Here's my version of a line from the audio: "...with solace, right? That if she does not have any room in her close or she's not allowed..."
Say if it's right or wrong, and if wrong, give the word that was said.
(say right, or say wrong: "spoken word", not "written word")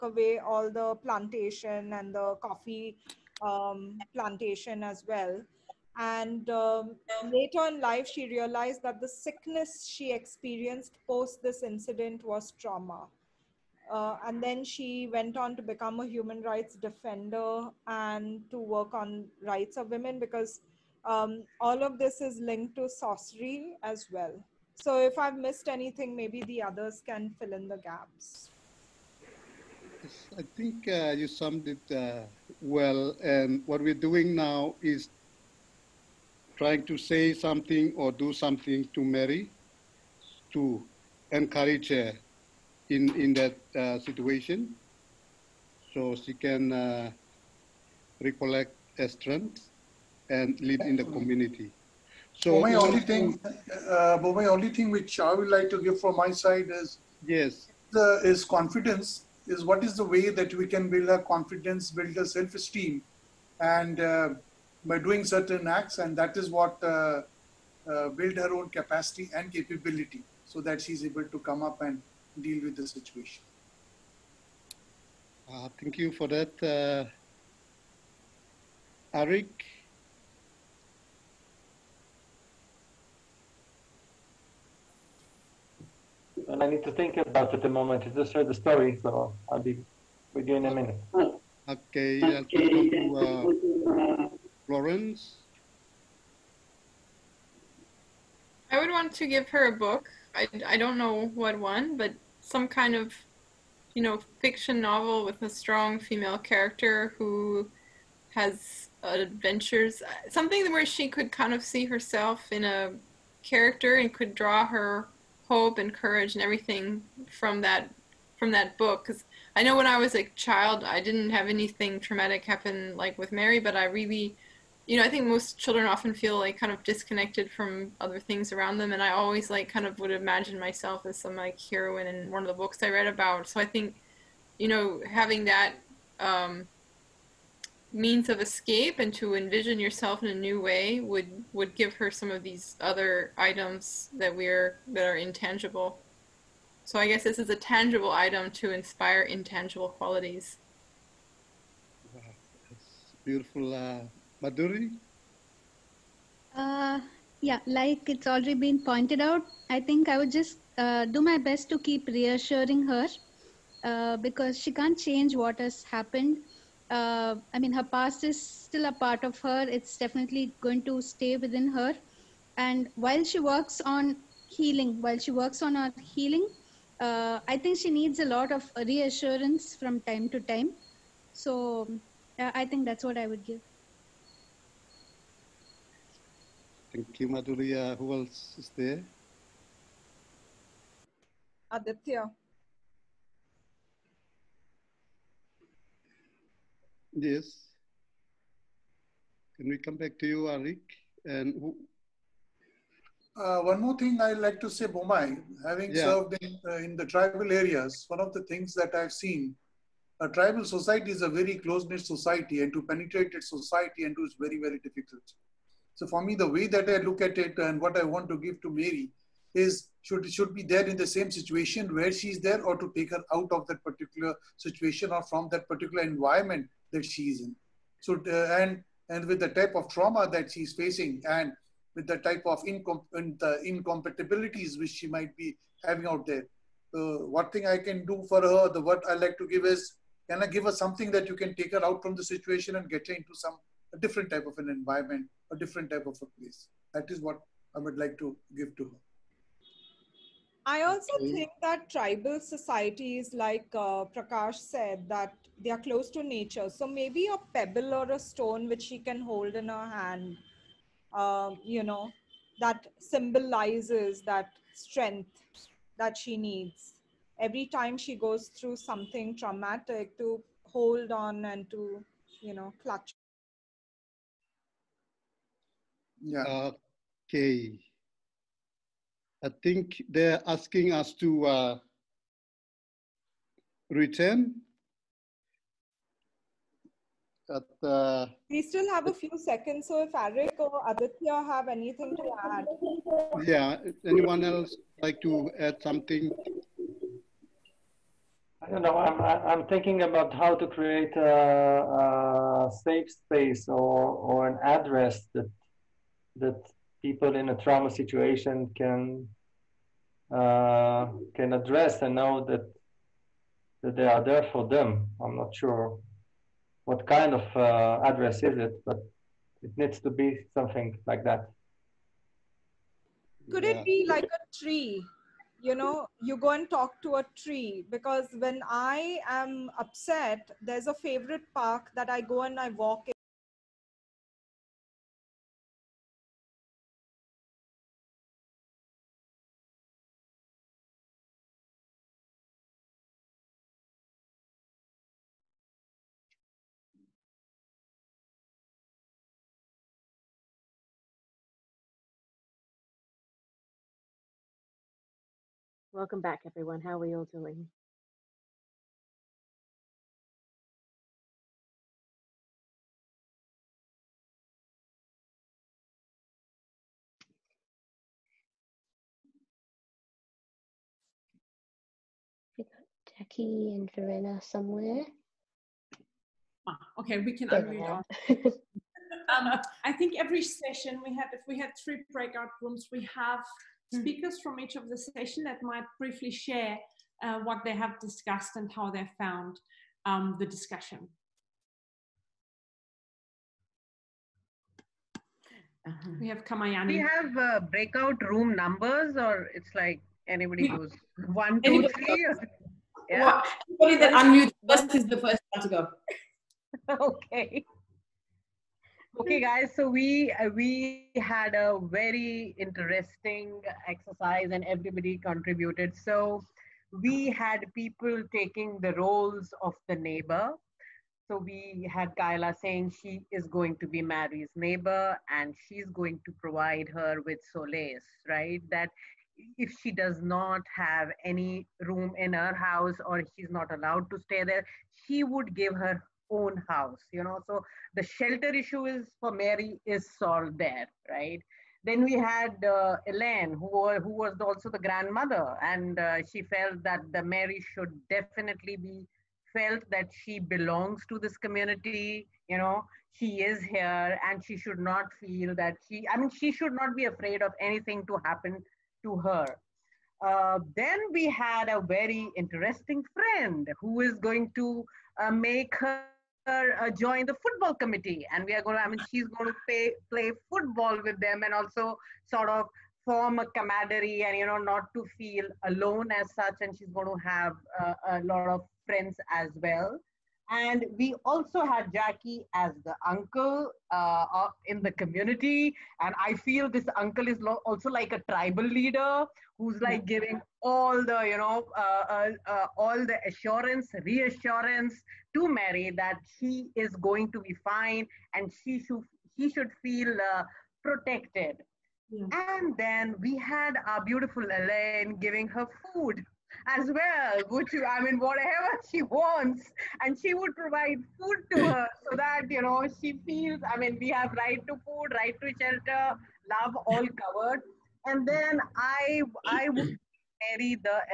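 wrong: "house", not "close".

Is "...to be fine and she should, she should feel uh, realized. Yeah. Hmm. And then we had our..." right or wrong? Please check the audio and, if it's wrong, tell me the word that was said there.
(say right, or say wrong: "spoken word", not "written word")
wrong: "protected", not "realized".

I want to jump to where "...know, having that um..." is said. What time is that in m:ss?
2:14.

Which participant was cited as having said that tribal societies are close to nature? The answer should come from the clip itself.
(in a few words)
Prakash.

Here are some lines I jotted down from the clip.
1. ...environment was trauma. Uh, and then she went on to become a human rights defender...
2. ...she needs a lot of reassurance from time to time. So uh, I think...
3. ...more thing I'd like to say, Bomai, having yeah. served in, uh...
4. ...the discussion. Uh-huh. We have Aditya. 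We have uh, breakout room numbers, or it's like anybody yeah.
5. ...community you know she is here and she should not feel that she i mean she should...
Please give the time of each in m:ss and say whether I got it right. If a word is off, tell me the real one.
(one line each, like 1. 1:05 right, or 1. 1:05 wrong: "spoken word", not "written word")
1. 0:11 wrong: "incident", not "environment"
2. 2:57 right
3. 3:23 right
4. 6:30 wrong: "Kamayani", not "Aditya"
5. 7:31 right.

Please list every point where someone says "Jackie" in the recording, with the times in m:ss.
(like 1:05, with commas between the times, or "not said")
6:13, 8:01.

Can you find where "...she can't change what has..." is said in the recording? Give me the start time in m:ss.
2:44.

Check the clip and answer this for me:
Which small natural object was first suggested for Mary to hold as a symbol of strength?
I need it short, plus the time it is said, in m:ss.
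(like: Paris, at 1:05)
A pebble, at 4:17.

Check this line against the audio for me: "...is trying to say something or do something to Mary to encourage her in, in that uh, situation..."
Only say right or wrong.
right.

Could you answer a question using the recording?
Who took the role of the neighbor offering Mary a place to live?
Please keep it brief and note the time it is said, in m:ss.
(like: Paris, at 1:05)
Kyla, at 7:02.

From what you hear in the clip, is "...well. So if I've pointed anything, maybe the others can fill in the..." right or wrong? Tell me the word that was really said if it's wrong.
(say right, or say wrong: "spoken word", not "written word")
wrong: "missed", not "pointed".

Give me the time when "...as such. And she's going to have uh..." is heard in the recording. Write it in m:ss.
7:56.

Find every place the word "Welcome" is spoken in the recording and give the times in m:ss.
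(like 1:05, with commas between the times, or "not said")
5:55.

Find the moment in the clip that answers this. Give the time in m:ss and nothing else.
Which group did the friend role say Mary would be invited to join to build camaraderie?
7:47.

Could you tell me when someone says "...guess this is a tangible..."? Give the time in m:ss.
2:27.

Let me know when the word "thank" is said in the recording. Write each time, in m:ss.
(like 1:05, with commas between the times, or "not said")
1:15, 3:06.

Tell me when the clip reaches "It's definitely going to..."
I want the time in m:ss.
2:49.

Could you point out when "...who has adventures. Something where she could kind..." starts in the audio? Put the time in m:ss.
1:47.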